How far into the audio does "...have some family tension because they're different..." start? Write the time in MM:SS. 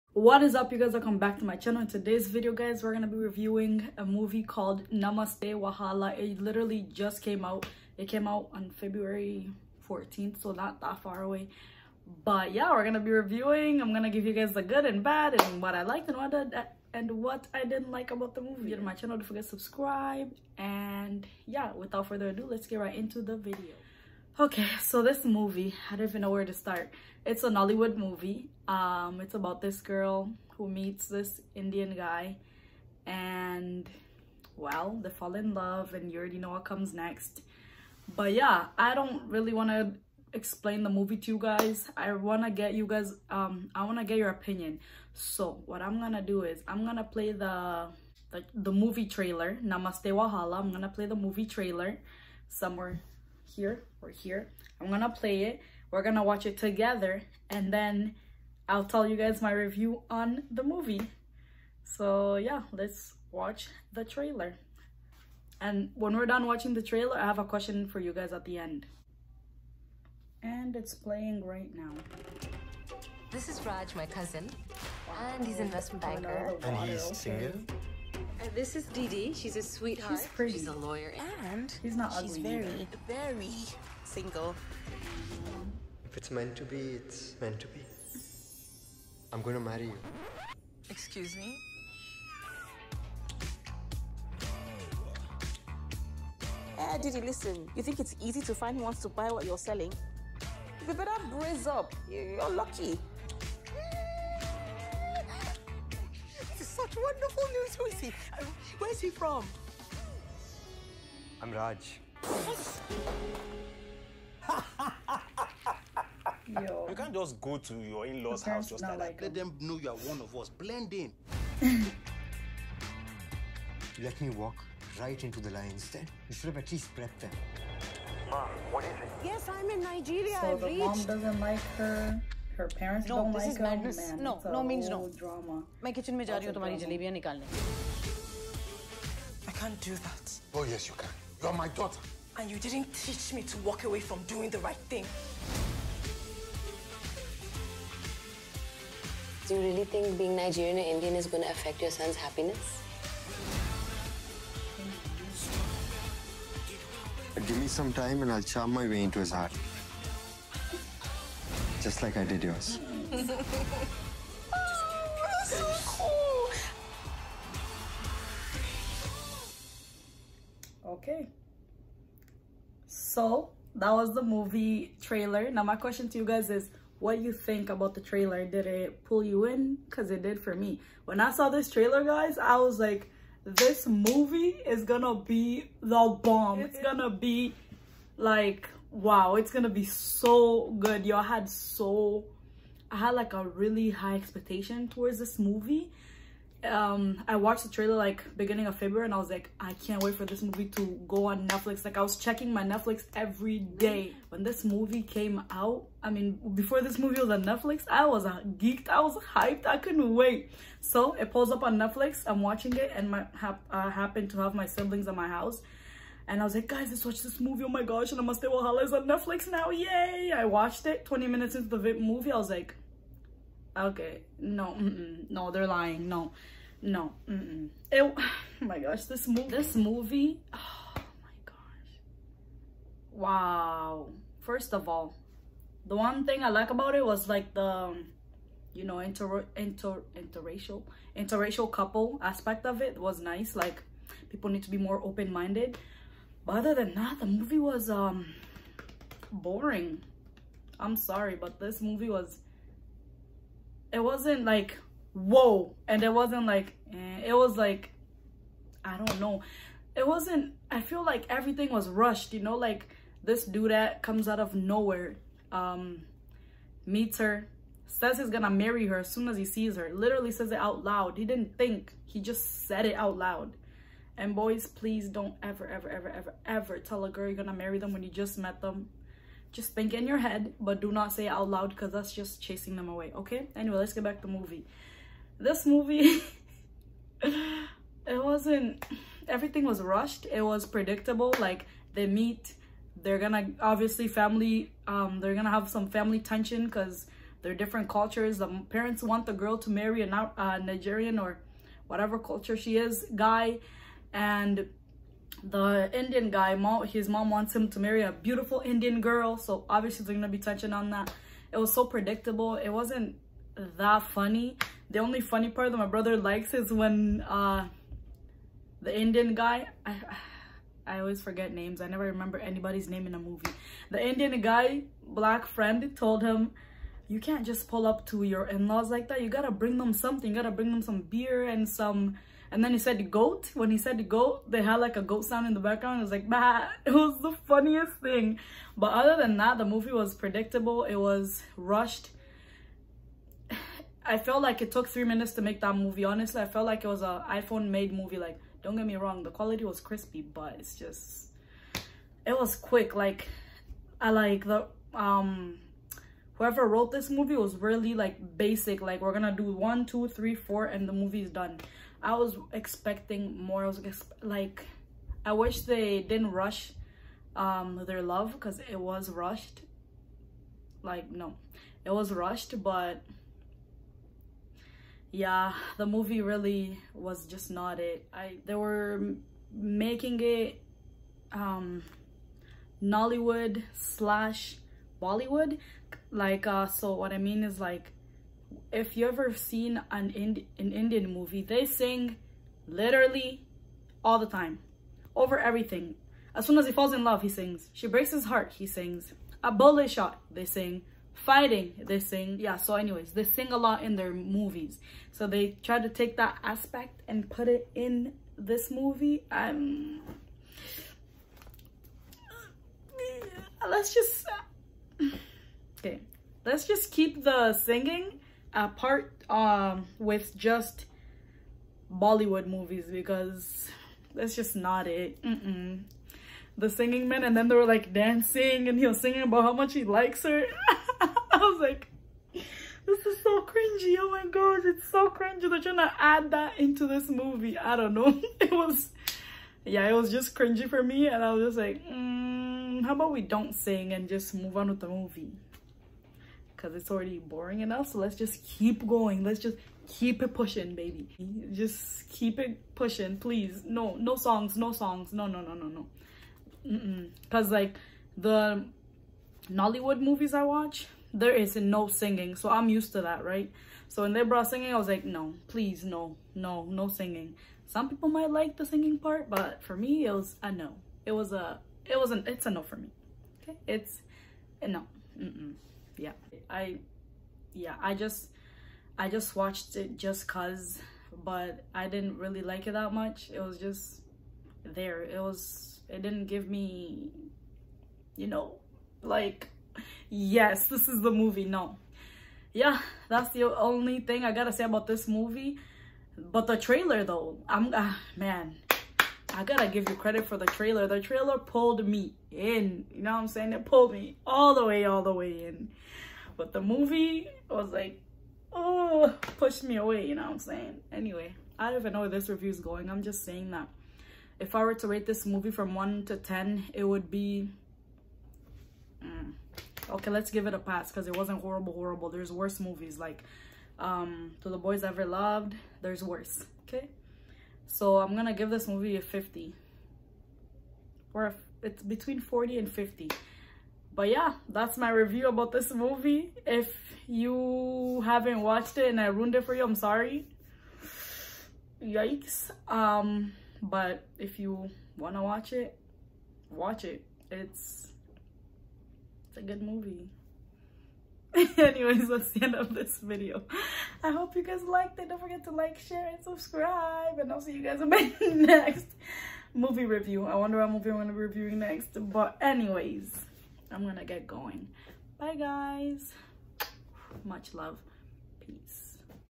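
04:55.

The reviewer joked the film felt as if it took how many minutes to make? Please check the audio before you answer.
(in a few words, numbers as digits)
3.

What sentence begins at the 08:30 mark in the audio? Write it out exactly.
Anyway, I don't even know where this review is going.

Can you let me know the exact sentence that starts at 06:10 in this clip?
Like, no, it was rushed, but yeah, the movie really was just not it.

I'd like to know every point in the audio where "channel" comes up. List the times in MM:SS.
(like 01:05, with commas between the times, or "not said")
00:01, 00:18.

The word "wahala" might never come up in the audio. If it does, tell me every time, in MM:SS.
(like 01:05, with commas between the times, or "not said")
00:05, 00:50, 03:38.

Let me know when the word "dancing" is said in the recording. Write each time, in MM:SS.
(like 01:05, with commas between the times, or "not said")
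07:07.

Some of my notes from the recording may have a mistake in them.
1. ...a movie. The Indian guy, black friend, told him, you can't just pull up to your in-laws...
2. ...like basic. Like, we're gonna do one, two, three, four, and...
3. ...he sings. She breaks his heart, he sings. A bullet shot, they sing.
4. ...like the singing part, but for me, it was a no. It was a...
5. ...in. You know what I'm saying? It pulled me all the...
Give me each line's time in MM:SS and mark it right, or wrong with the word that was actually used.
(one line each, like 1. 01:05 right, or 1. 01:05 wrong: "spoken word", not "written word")
1. 05:23 right
2. 05:57 right
3. 06:37 right
4. 07:48 right
5. 08:22 right.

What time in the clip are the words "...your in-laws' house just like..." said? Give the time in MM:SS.
01:57.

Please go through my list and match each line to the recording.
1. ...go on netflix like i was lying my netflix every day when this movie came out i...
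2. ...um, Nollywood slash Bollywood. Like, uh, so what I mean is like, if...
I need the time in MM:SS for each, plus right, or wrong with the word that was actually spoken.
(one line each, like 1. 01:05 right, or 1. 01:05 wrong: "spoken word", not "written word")
1. 03:21 wrong: "checking", not "lying"
2. 06:21 right.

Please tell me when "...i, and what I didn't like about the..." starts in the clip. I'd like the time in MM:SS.
00:16.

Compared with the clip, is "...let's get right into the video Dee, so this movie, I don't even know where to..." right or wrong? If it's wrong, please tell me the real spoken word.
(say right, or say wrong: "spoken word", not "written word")
wrong: "Okay", not "Dee".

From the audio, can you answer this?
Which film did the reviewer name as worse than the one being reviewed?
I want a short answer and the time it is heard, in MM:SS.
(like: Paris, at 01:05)
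To the Boys Ever Loved, at 08:44.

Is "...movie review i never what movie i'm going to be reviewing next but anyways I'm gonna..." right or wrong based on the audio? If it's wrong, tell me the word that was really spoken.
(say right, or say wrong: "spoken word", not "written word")
wrong: "wonder", not "never".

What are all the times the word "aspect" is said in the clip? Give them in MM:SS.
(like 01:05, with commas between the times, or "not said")
04:02, 06:46.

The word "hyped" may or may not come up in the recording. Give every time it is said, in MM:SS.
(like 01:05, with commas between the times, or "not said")
03:29.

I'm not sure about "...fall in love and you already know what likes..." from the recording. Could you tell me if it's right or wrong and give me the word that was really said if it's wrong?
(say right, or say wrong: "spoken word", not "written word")
wrong: "comes", not "likes".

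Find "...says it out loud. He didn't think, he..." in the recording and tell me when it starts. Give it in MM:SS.
04:30.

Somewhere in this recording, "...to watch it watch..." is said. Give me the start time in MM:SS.
09:05.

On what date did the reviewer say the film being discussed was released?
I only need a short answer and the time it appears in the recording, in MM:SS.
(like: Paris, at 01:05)
February 14th, at 00:08.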